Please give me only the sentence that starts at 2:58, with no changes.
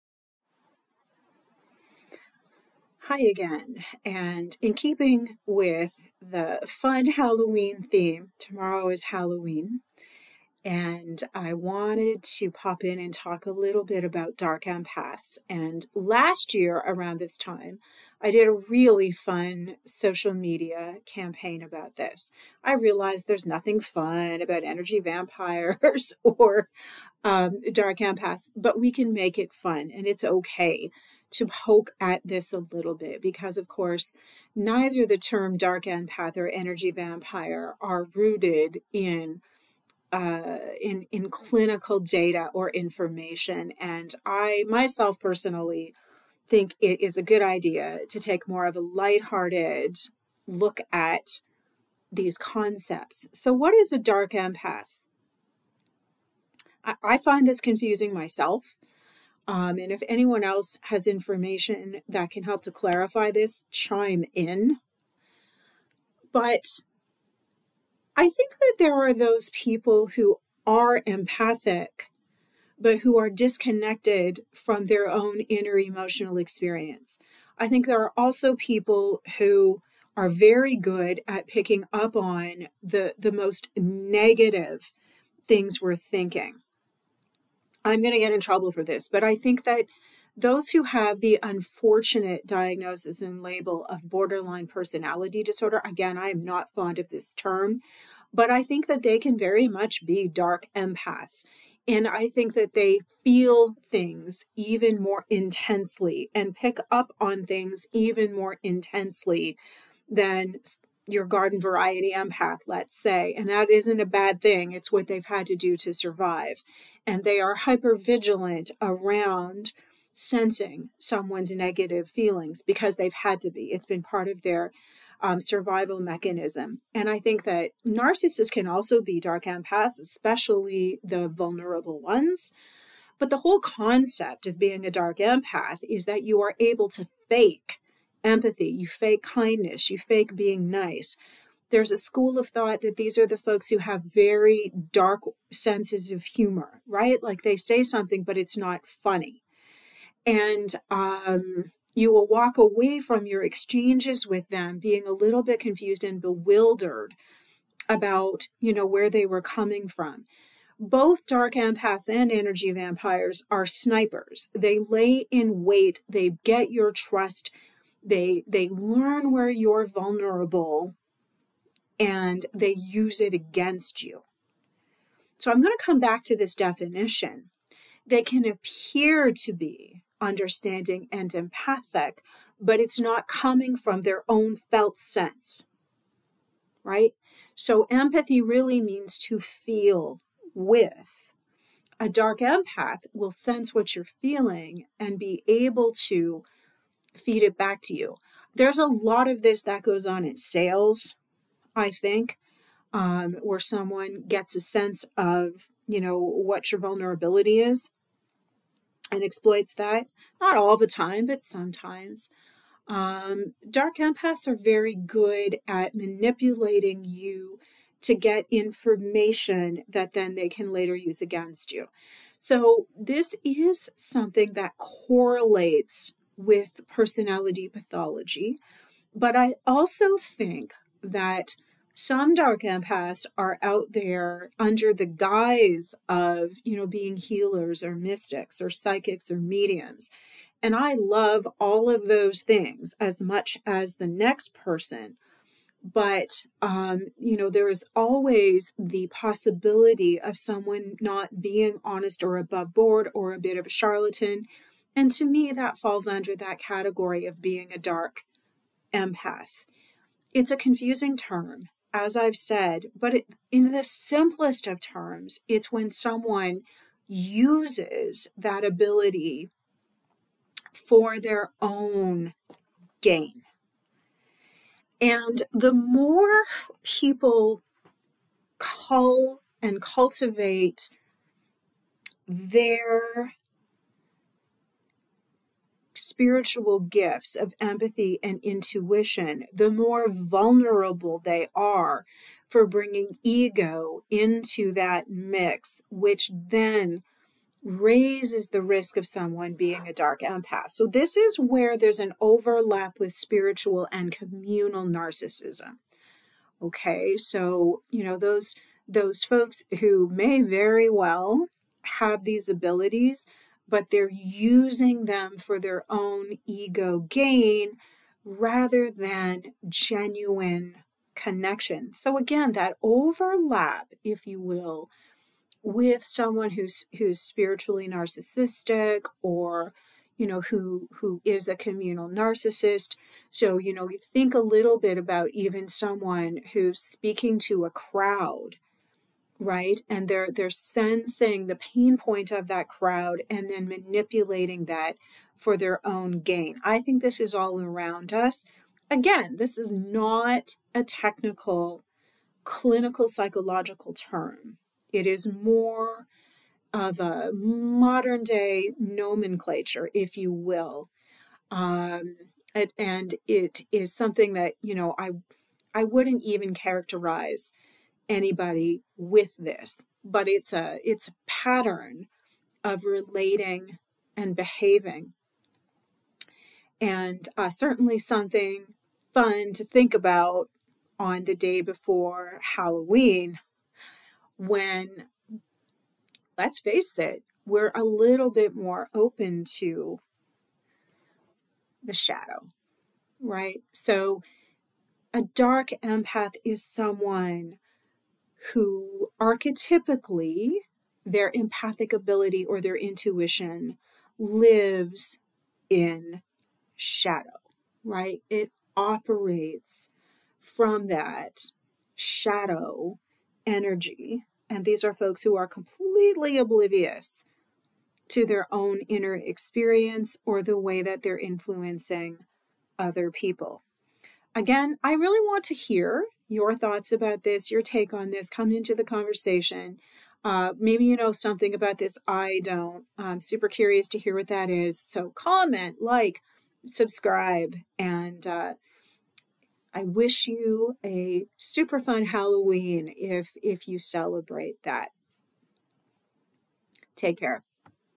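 They can appear to be understanding and empathic, but it's not coming from their own felt sense.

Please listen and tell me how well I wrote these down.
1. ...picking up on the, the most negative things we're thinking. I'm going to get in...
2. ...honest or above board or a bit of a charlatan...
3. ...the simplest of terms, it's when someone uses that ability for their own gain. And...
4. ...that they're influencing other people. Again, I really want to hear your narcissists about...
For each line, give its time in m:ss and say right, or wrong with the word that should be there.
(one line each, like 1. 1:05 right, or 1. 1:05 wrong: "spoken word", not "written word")
1. 1:21 right
2. 4:11 right
3. 4:23 right
4. 7:00 wrong: "thoughts", not "narcissists".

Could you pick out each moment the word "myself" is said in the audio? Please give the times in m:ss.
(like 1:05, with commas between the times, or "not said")
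0:44, 0:58.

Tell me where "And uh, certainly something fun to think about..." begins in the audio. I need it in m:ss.
6:16.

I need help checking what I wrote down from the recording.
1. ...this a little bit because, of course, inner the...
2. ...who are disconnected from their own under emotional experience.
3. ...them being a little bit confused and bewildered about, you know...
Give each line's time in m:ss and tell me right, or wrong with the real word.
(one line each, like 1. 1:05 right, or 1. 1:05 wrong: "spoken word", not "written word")
1. 0:32 wrong: "neither", not "inner"
2. 1:12 wrong: "inner", not "under"
3. 2:34 right.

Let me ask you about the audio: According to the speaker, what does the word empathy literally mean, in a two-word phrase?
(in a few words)
to feel with.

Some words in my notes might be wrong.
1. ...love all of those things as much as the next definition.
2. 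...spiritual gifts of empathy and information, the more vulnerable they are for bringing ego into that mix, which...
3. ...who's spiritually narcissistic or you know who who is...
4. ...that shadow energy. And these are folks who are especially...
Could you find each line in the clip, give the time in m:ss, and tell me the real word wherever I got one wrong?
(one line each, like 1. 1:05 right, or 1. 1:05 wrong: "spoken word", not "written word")
1. 4:00 wrong: "person", not "definition"
2. 4:46 wrong: "intuition", not "information"
3. 5:26 right
4. 6:50 wrong: "completely", not "especially".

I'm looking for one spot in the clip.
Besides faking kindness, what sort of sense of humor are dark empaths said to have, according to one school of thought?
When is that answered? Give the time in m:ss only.
2:24.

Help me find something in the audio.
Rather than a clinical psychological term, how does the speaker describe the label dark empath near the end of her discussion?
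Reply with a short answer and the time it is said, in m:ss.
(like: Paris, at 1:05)
modern day nomenclature, at 5:57.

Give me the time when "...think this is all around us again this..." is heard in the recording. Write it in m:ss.
5:46.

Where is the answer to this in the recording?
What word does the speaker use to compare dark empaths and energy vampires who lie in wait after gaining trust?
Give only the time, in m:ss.
2:43.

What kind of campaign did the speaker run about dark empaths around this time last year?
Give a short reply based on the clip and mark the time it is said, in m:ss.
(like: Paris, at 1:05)
social media campaign, at 0:19.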